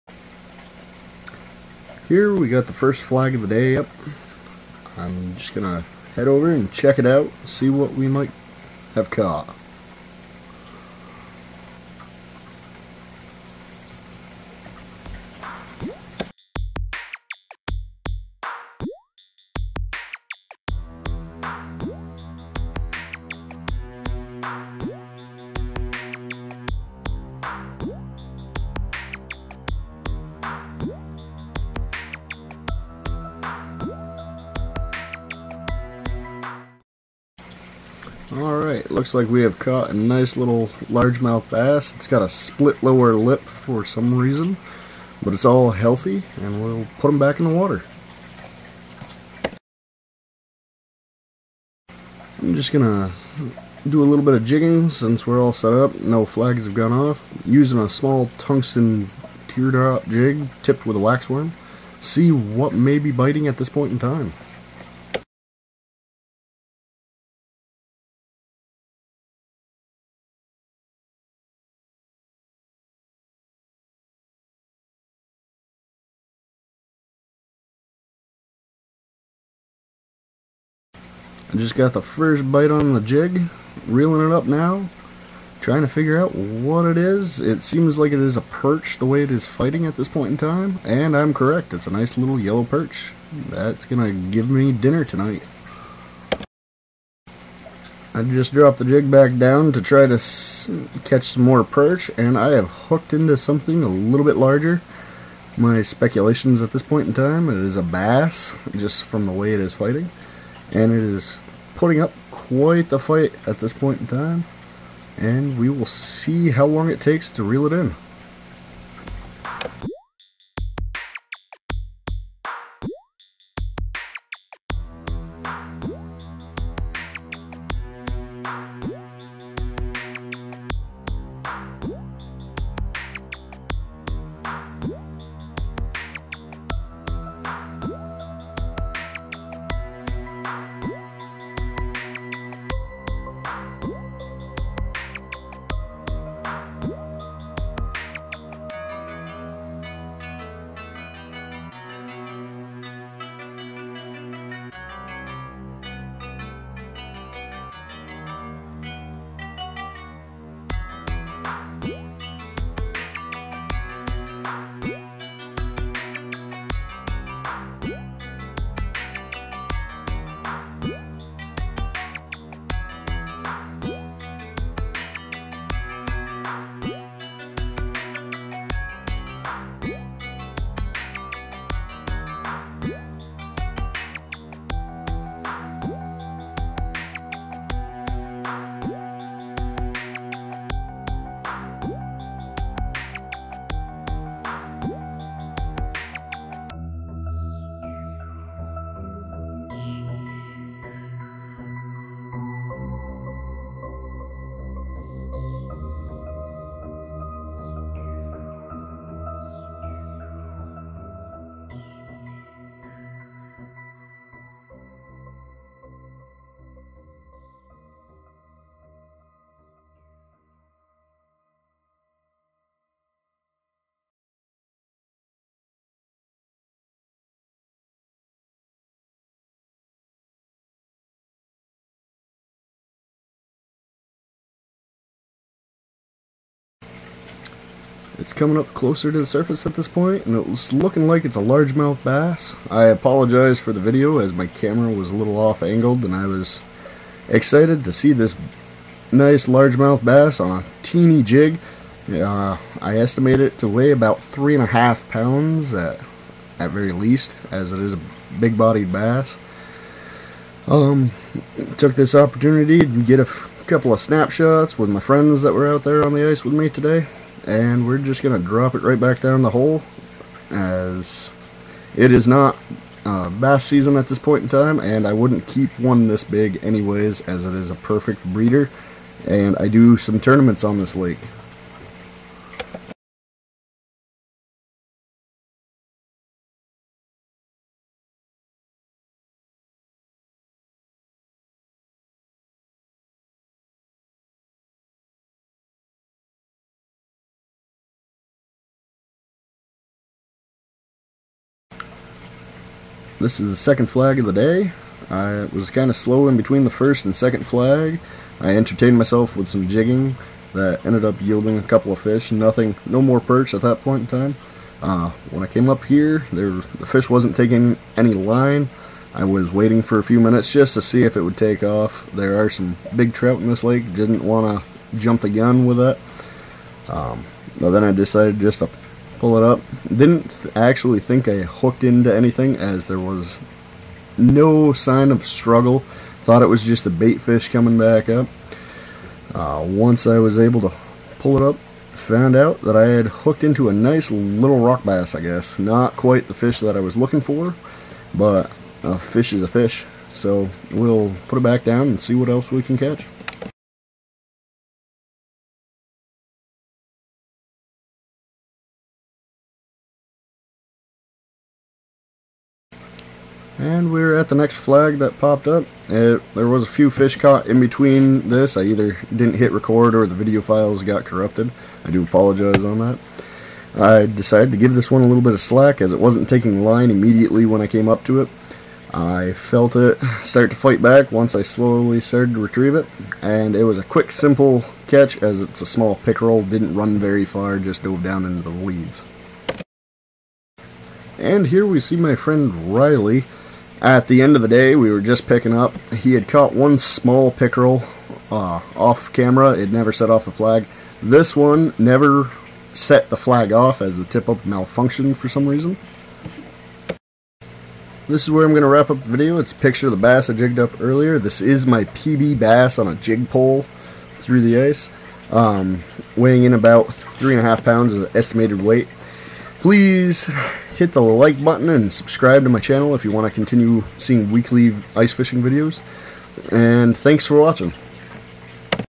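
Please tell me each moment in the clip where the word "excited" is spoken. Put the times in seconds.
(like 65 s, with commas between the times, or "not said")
247 s.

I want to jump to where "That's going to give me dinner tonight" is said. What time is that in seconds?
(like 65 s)
93 s.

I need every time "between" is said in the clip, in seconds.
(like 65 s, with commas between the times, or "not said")
306 s, 367 s.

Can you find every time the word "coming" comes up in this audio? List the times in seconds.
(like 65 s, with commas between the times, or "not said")
238 s, 337 s.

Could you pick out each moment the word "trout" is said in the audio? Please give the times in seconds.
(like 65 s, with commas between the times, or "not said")
323 s.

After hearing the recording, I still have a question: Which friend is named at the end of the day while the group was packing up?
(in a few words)
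Riley.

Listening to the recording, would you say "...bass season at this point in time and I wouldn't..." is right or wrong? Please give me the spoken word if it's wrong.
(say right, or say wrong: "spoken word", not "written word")
right.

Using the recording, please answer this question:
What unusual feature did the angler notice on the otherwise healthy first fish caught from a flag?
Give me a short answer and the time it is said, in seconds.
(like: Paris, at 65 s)
Split lower lip, at 42 s.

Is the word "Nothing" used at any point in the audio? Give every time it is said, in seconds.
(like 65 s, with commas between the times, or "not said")
312 s.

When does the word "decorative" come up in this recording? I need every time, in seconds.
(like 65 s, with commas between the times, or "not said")
not said.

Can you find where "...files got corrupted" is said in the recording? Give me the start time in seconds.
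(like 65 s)
370 s.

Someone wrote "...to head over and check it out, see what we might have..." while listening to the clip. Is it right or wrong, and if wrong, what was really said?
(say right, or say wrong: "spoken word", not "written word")
right.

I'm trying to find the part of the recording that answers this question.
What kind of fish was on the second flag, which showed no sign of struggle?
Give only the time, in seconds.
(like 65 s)
344 s.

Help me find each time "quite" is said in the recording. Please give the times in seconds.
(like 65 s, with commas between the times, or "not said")
112 s, 345 s.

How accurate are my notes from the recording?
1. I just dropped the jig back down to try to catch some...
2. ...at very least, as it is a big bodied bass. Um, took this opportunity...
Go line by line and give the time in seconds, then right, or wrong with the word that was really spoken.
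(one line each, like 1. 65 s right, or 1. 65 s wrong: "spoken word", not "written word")
1. 98 s right
2. 256 s right.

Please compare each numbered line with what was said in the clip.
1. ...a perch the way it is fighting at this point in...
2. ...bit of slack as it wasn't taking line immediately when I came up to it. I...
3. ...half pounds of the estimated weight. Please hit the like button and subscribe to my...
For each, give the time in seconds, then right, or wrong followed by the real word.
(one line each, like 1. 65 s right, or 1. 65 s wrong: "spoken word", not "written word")
1. 88 s right
2. 375 s right
3. 417 s right.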